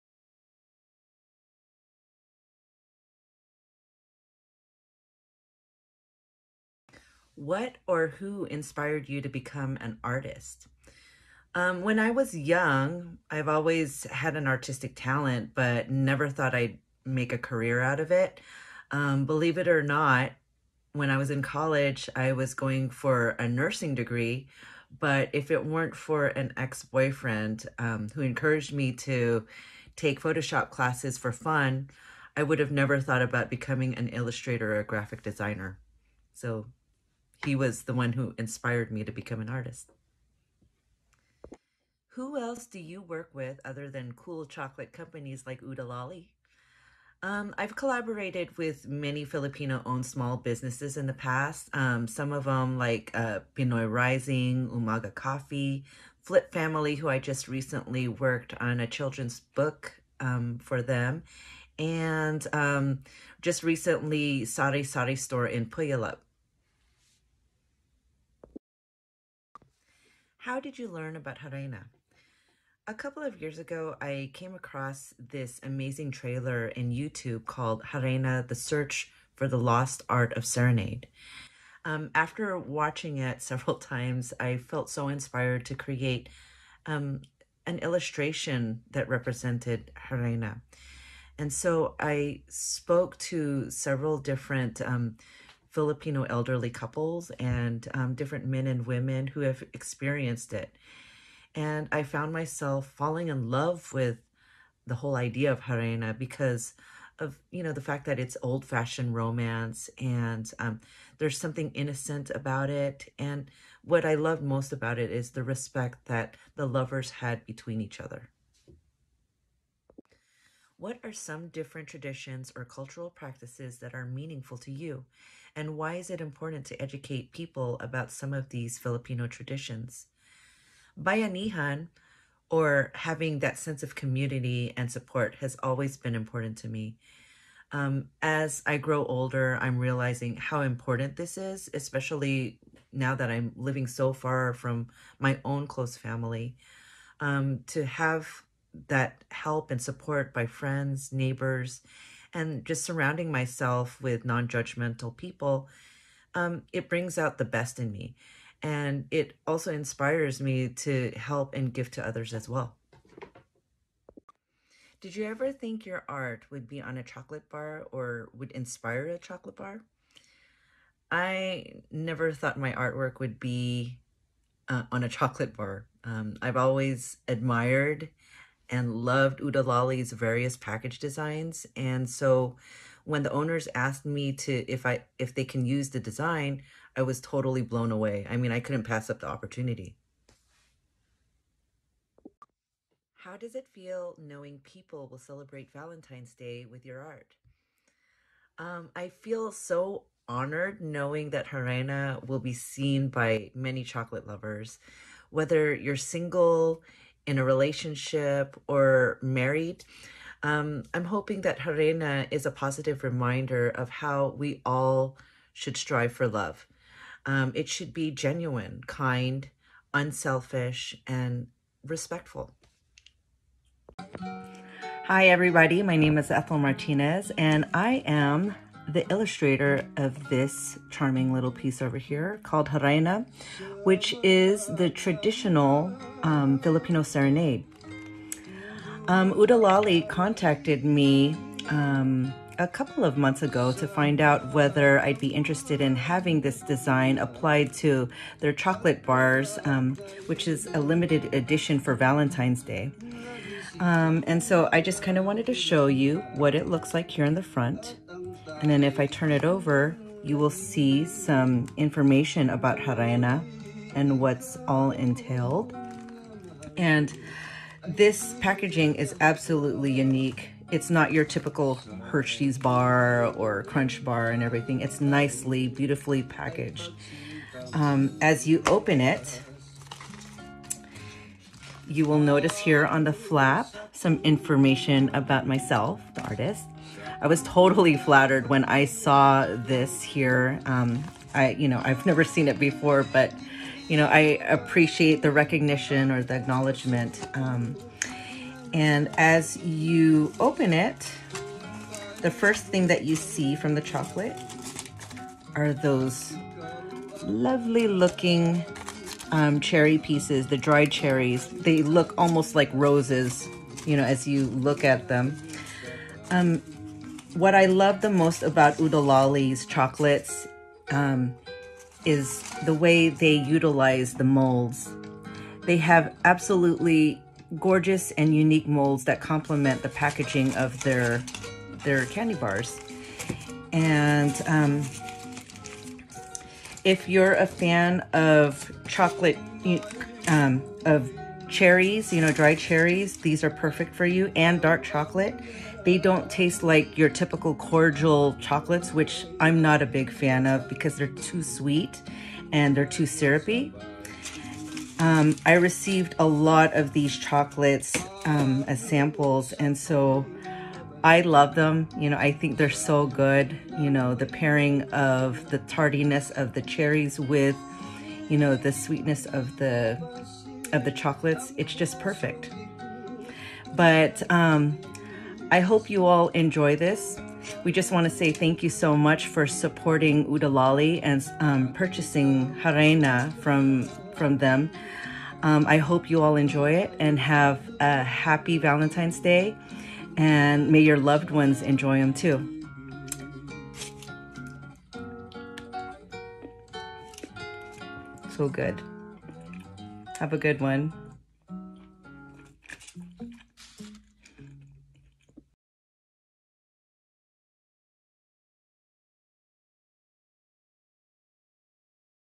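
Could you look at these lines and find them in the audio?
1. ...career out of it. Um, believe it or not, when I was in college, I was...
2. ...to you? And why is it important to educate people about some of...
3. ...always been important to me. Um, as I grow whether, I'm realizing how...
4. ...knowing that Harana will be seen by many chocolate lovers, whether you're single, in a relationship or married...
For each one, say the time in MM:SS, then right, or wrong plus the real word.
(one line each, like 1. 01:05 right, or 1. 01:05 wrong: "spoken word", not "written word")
1. 00:17 right
2. 02:04 right
3. 02:15 wrong: "older", not "whether"
4. 03:20 right.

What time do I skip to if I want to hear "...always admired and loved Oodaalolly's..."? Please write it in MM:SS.
02:56.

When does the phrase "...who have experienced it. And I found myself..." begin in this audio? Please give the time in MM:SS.
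01:39.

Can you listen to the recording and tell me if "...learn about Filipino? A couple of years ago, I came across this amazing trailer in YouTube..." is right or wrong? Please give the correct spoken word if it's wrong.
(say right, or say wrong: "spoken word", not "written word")
wrong: "Harana", not "Filipino".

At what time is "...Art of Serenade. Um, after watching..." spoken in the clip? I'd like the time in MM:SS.
01:20.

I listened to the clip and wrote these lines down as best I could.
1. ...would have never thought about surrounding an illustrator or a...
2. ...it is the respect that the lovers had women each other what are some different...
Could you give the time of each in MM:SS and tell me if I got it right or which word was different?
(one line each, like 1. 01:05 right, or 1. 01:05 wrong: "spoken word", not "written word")
1. 00:32 wrong: "becoming", not "surrounding"
2. 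01:54 wrong: "between", not "women".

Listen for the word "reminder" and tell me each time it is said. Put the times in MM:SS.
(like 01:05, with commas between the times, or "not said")
03:33.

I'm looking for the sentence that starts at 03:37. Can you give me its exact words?
Um, it should be genuine, kind, unselfish, and respectful.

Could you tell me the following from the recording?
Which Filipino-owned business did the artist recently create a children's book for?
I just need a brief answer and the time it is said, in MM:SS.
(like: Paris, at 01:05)
Flip Family, at 00:56.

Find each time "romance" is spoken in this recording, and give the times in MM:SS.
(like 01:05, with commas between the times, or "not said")
01:49.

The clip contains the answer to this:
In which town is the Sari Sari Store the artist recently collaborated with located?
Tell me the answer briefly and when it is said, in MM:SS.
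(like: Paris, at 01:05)
Puyallup, at 01:05.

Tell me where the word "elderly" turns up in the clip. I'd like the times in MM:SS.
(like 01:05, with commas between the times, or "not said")
01:36.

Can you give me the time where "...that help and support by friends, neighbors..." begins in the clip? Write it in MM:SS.
02:28.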